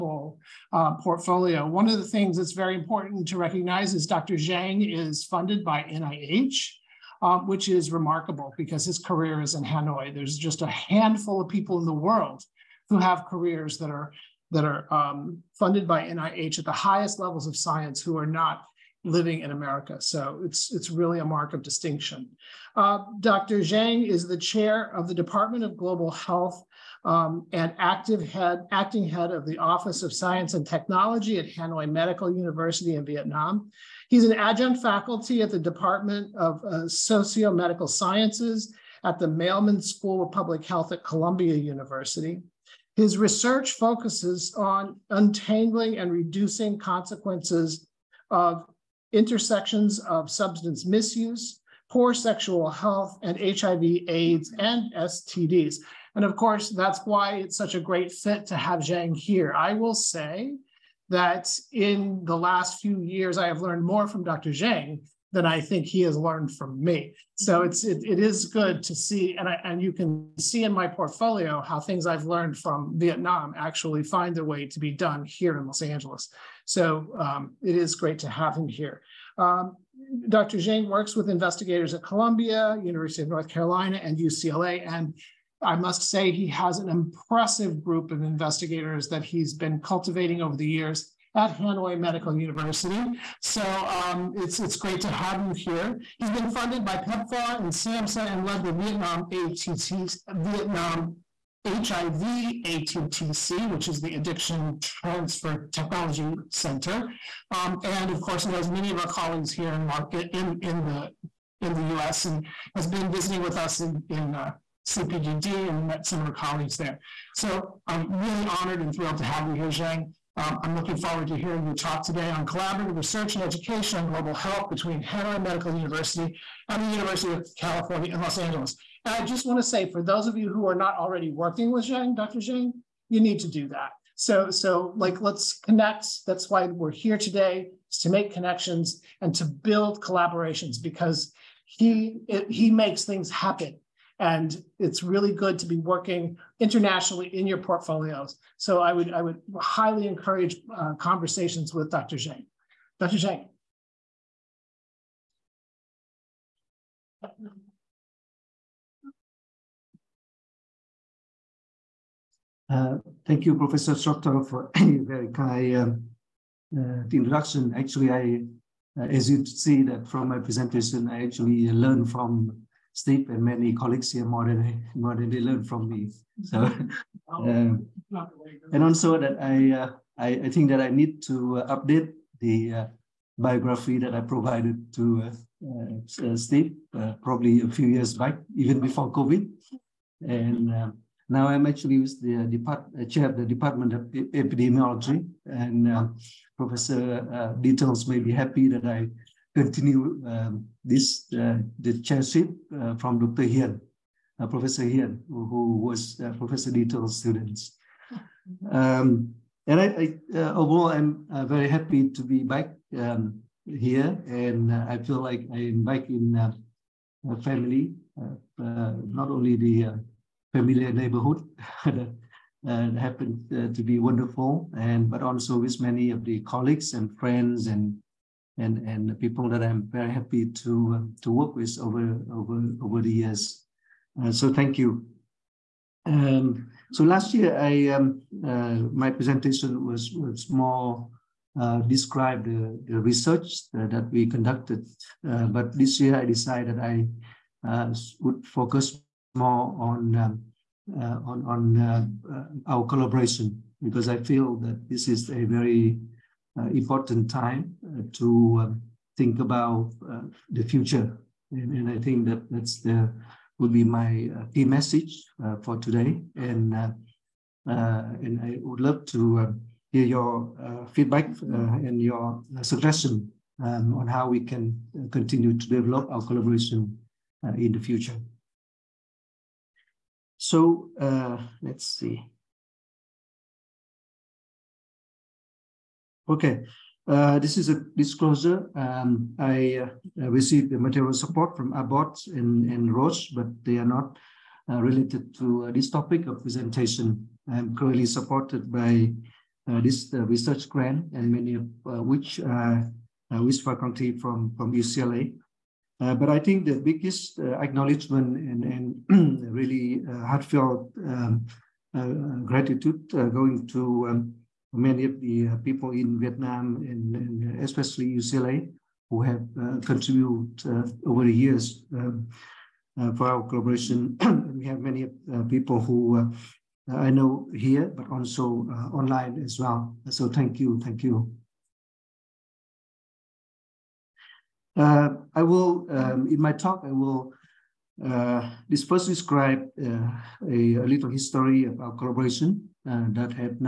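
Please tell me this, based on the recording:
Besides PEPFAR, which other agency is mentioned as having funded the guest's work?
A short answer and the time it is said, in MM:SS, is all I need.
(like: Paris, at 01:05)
SAMHSA, at 01:37.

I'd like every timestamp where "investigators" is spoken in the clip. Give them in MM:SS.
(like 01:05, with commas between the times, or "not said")
01:21, 01:28.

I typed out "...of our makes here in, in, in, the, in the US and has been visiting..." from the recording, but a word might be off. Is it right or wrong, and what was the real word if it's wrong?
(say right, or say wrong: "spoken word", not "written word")
wrong: "colleagues", not "makes".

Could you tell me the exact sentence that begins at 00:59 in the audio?
I will say that in the last few years, I have learned more from Dr.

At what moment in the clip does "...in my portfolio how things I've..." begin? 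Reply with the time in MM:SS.
01:10.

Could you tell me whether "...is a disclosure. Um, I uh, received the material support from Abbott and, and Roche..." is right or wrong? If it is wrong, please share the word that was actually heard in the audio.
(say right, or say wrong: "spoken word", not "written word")
right.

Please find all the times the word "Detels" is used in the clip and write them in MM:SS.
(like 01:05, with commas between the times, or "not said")
03:17, 03:26.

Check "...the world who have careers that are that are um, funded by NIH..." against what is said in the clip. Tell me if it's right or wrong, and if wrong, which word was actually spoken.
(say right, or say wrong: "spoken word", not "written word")
right.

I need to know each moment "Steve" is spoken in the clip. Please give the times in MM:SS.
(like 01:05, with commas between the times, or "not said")
02:52, 03:06.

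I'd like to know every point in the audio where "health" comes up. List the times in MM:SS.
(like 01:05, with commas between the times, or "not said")
00:26, 00:40, 00:52, 02:04.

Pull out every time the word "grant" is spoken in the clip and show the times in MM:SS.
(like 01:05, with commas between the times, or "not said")
05:00.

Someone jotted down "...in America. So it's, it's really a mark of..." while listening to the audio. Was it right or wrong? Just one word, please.
right.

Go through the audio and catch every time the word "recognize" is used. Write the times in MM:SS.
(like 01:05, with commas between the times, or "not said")
00:03.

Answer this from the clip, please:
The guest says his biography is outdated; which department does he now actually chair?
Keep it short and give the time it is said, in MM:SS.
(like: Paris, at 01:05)
Department of Epidemiology, at 03:13.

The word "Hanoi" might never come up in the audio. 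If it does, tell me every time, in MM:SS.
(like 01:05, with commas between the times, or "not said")
00:09, 00:31, 01:31, 02:05.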